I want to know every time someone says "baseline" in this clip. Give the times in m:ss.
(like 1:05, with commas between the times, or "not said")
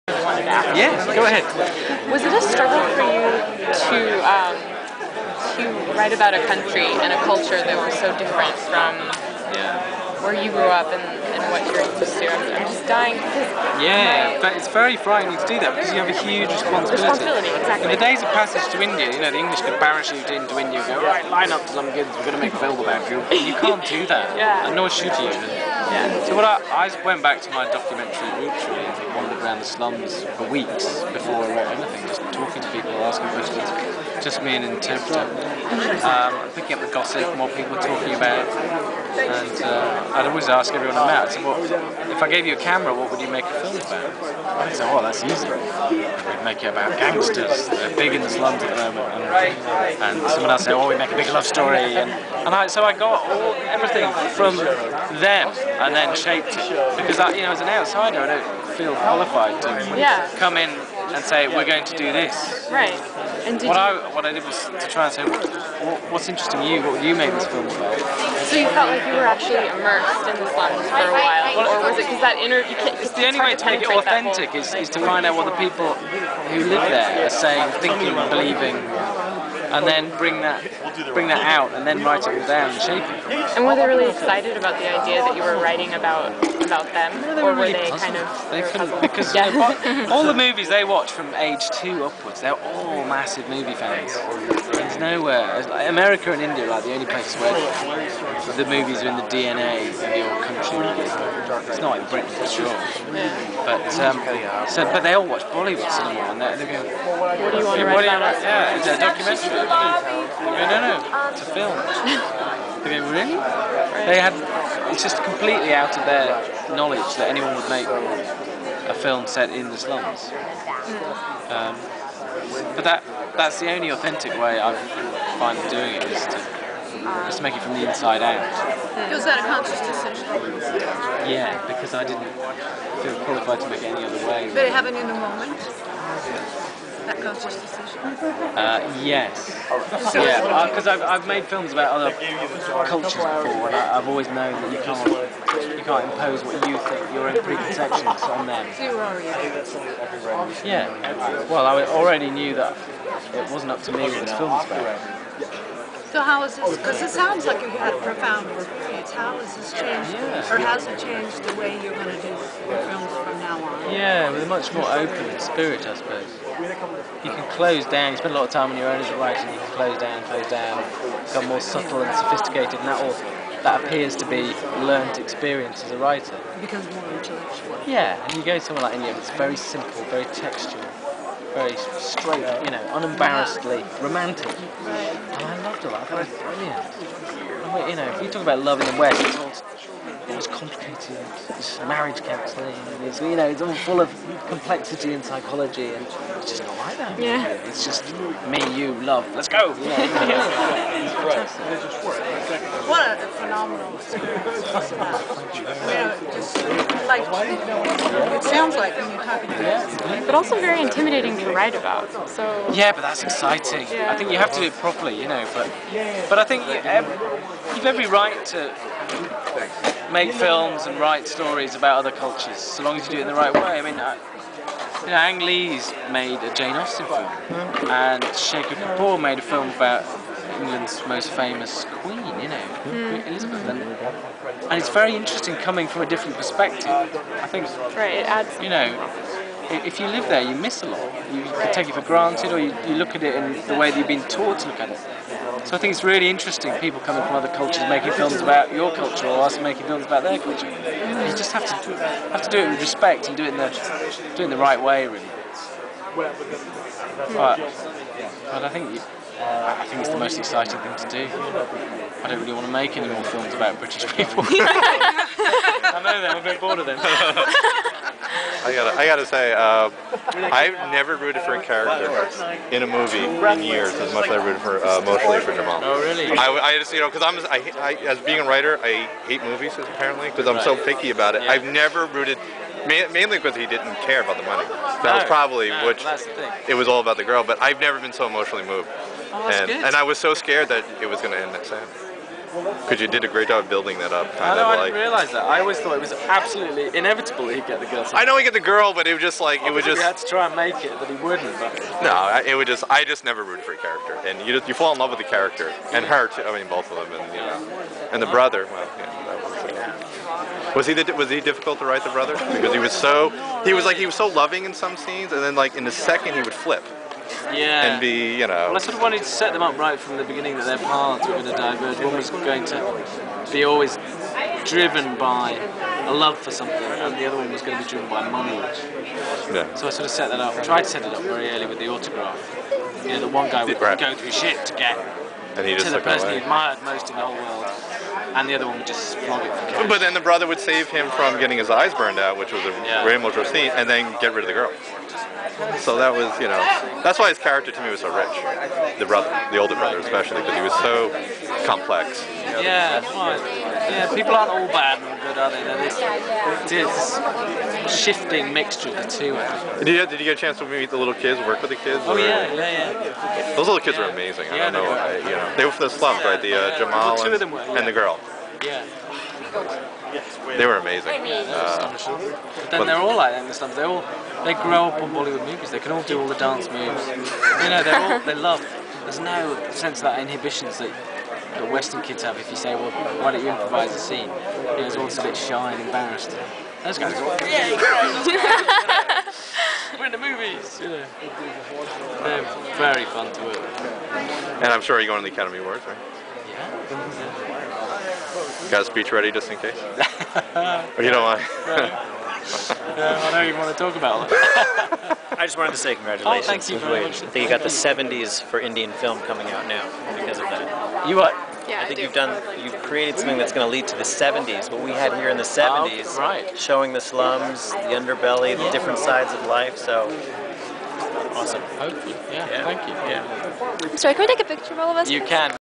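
not said.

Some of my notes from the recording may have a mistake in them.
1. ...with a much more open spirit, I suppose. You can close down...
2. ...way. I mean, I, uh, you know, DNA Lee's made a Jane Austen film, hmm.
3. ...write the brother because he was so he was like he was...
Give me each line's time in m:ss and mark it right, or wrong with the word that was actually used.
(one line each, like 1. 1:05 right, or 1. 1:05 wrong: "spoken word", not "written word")
1. 2:44 right
2. 3:43 wrong: "Ang", not "DNA"
3. 5:11 right.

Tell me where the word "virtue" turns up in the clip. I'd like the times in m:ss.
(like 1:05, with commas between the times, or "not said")
not said.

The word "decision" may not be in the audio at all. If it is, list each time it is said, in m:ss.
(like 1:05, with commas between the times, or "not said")
2:09, 2:17.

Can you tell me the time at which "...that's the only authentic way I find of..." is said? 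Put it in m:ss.
2:03.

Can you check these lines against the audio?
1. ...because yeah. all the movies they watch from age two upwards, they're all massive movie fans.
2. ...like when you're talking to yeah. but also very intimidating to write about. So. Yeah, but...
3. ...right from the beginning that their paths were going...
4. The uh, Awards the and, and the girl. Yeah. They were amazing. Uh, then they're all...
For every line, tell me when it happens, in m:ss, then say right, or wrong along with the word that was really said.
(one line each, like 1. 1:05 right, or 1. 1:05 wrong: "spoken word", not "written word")
1. 1:29 right
2. 3:28 right
3. 5:19 right
4. 6:06 wrong: "Jamal", not "Awards".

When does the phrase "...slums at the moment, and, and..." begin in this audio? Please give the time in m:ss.
0:48.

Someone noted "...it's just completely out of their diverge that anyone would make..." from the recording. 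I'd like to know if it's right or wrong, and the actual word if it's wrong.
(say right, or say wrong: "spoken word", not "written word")
wrong: "knowledge", not "diverge".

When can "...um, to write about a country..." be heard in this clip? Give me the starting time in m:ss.
0:04.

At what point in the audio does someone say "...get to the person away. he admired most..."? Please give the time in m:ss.
5:34.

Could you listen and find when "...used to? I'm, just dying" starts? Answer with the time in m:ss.
0:11.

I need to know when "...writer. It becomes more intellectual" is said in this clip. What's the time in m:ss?
2:55.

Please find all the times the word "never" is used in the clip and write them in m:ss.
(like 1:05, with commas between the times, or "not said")
4:30, 4:41, 4:47, 5:03.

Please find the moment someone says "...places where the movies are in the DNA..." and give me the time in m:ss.
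1:37.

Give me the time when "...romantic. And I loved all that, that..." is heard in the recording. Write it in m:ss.
3:04.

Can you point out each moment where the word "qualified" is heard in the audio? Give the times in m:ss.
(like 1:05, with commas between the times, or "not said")
0:58, 2:13.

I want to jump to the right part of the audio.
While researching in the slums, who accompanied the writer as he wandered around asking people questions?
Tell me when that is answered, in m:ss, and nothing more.
0:34.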